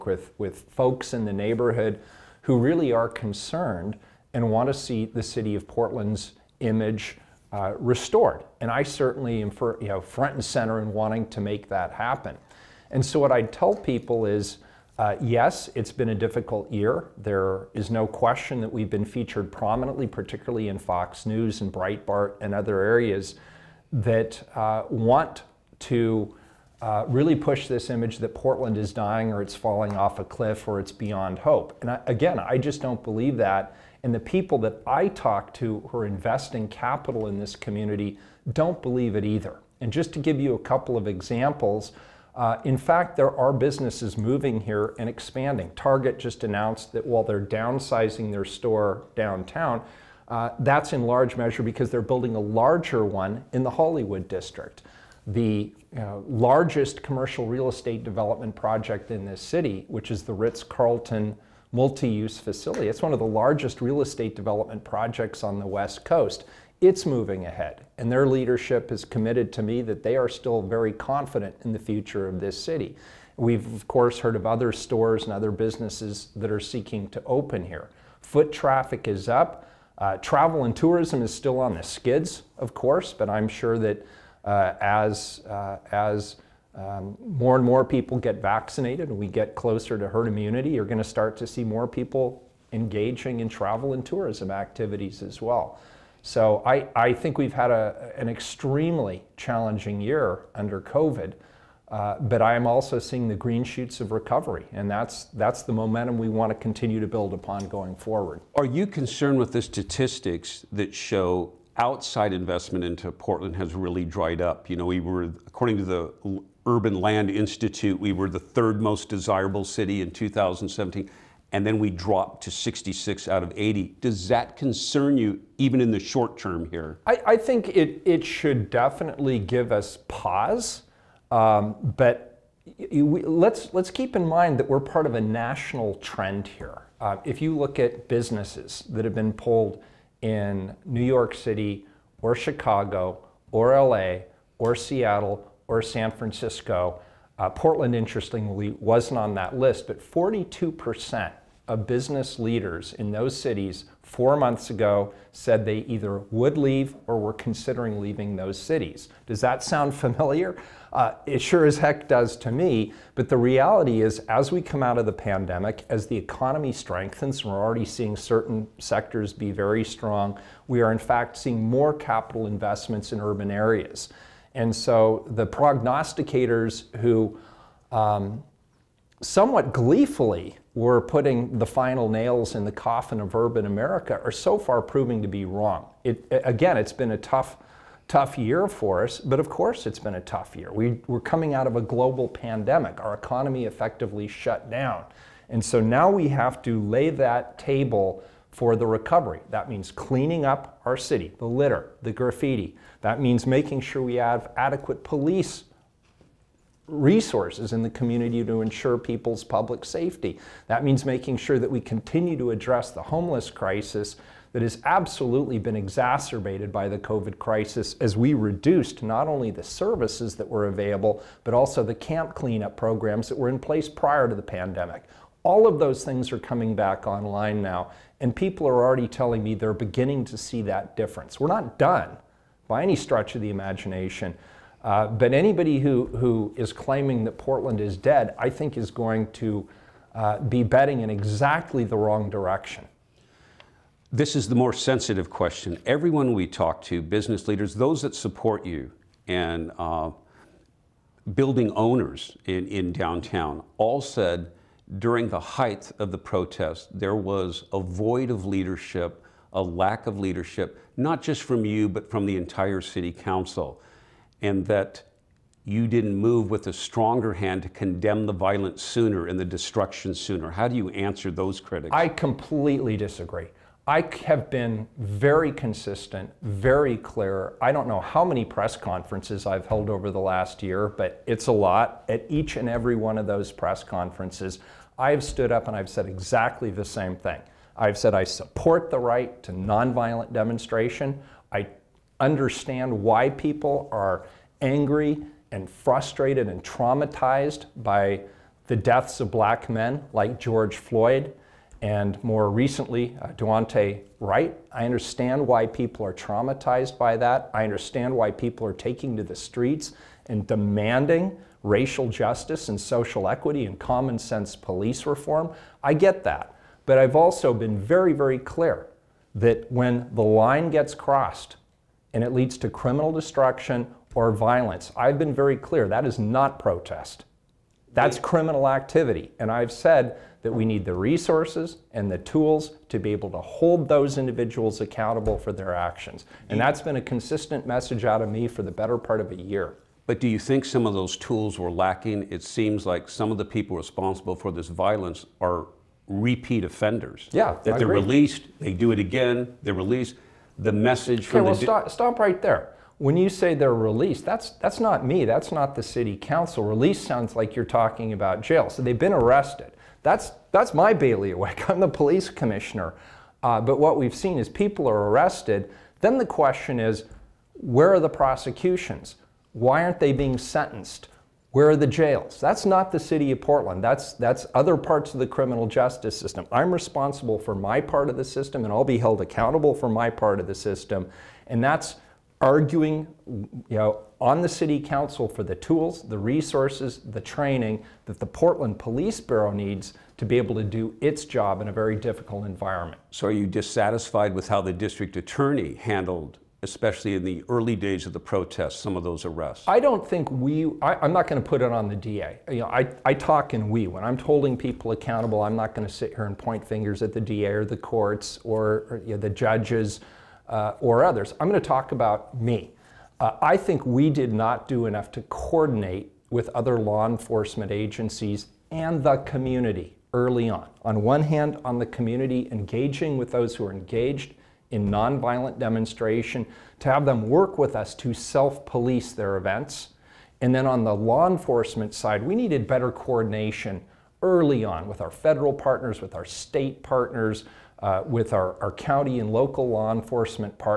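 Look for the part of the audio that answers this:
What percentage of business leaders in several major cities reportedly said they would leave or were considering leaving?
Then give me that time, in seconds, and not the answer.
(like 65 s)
149 s.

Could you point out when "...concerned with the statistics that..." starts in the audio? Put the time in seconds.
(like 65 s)
108 s.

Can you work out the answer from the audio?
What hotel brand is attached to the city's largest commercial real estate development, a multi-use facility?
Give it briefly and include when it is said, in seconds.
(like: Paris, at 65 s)
Ritz Carlton, at 60 s.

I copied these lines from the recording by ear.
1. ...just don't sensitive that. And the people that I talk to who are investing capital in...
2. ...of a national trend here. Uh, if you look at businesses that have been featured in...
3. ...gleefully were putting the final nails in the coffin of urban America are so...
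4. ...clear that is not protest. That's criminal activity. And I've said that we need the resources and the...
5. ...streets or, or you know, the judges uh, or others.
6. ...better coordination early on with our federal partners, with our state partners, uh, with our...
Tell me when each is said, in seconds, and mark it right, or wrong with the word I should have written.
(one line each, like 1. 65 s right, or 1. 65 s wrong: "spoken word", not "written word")
1. 32 s wrong: "believe", not "sensitive"
2. 135 s wrong: "pulled", not "featured"
3. 179 s right
4. 325 s right
5. 407 s wrong: "courts", not "streets"
6. 432 s right.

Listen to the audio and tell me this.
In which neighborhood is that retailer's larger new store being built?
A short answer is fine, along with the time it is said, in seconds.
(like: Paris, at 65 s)
Hollywood district, at 53 s.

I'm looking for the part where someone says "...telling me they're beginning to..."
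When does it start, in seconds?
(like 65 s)
229 s.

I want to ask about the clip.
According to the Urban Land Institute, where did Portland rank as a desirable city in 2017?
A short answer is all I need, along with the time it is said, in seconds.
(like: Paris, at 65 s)
3rd, at 118 s.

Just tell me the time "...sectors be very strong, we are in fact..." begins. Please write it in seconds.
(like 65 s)
168 s.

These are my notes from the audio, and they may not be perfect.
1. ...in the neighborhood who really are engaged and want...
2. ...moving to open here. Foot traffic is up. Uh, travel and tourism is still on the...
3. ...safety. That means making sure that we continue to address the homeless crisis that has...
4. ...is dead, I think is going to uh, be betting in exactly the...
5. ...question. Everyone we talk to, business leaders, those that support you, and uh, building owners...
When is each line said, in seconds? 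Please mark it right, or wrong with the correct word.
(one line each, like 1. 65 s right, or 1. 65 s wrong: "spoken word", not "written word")
1. 1 s wrong: "concerned", not "engaged"
2. 76 s wrong: "seeking", not "moving"
3. 209 s right
4. 237 s right
5. 245 s right.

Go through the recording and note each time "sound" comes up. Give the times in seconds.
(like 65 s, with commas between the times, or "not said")
159 s, 357 s.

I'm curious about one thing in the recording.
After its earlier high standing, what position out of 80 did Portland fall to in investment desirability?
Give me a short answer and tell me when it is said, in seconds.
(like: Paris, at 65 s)
66, at 122 s.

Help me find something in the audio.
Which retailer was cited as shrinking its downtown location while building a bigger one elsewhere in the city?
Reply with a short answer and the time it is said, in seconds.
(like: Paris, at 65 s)
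Target, at 45 s.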